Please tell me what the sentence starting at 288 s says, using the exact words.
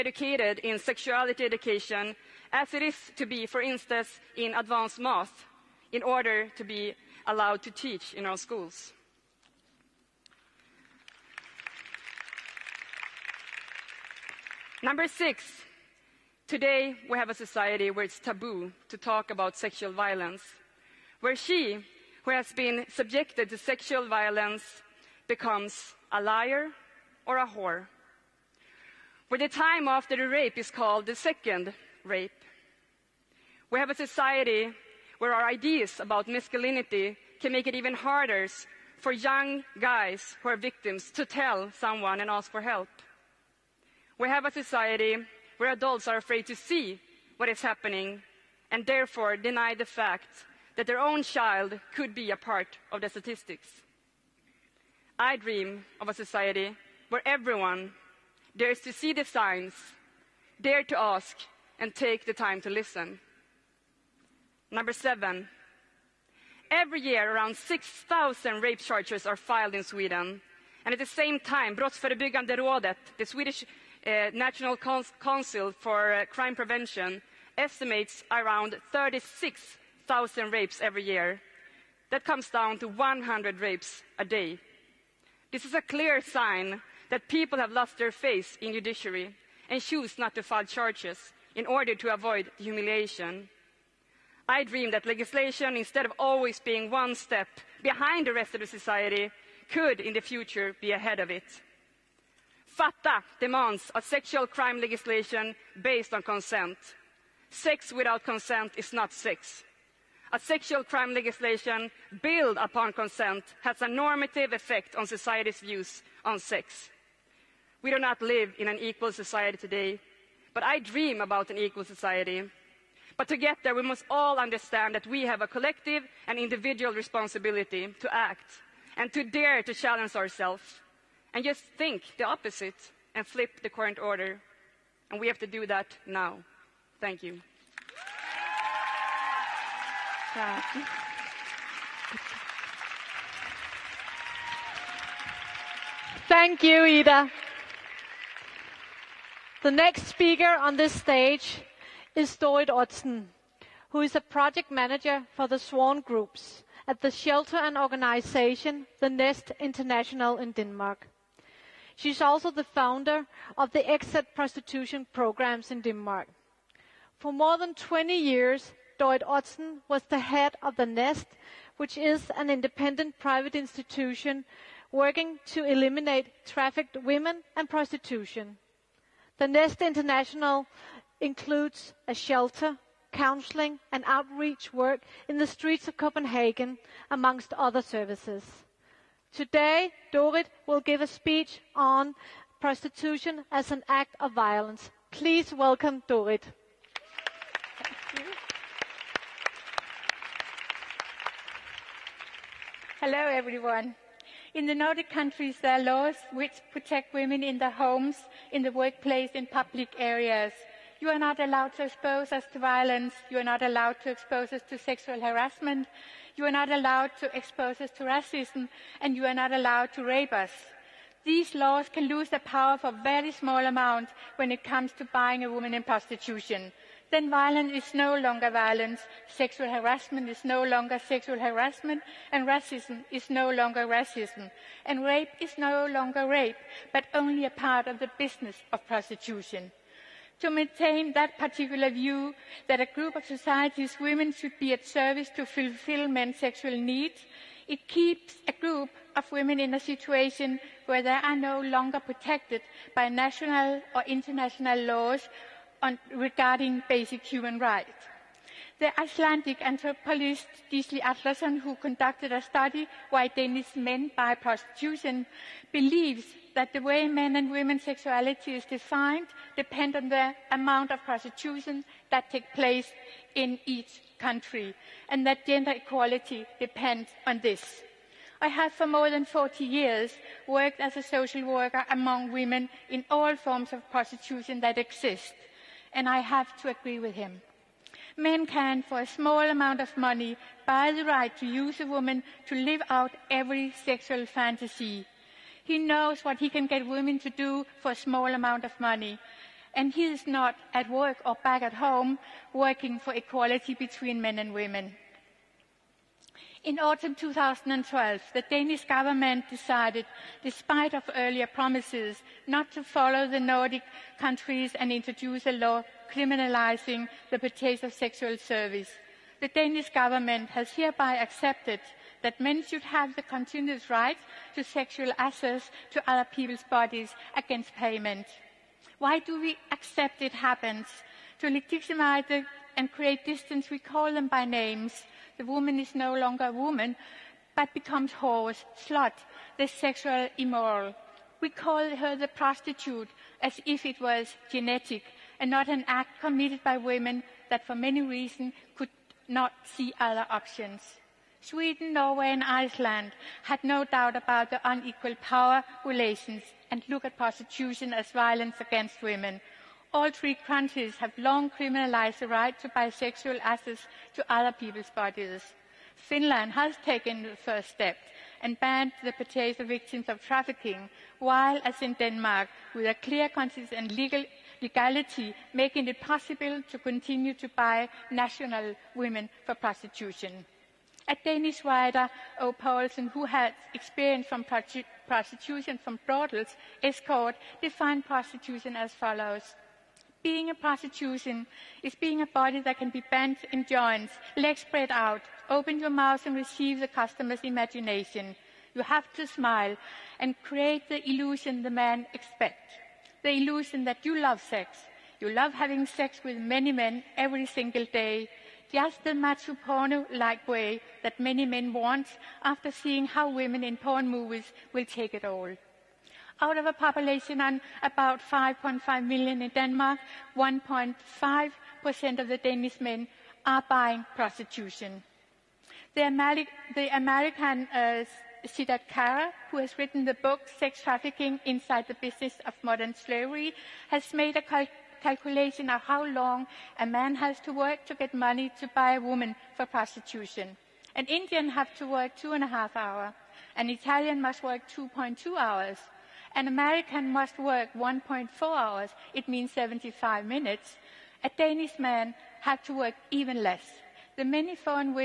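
Men can, for a small amount of money, buy the right to use a woman to live out every sexual fantasy.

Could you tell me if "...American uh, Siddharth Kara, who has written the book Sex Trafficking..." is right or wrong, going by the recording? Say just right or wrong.
right.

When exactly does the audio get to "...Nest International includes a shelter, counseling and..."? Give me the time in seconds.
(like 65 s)
179 s.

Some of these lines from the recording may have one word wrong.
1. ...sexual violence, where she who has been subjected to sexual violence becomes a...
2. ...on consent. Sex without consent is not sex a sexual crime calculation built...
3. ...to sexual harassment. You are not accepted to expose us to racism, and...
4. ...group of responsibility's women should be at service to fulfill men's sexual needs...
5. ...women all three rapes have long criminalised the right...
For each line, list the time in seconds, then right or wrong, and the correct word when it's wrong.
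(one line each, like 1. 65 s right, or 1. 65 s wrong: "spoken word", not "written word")
1. 19 s right
2. 106 s wrong: "legislation", not "calculation"
3. 214 s wrong: "allowed", not "accepted"
4. 242 s wrong: "society", not "responsibility"
5. 359 s wrong: "countries", not "rapes".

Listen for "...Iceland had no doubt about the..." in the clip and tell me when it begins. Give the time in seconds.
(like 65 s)
352 s.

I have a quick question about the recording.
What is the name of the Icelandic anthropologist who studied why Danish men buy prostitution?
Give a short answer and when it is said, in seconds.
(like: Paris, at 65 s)
Gisli Atlason, at 260 s.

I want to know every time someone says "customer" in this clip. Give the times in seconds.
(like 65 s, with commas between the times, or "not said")
396 s.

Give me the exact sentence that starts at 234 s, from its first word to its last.
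And rape is no longer rape, but only a part of the business of prostitution.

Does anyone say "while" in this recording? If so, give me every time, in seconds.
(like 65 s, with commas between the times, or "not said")
371 s.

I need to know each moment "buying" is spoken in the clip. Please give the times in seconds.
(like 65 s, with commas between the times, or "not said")
225 s, 423 s.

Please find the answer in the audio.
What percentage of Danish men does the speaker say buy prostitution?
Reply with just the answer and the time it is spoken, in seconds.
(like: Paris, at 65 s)
1.5%, at 420 s.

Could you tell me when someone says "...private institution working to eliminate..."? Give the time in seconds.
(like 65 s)
173 s.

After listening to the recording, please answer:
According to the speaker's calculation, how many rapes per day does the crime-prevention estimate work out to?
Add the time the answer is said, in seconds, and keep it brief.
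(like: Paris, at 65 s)
100, at 82 s.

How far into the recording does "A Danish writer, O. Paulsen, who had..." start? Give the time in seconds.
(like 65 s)
381 s.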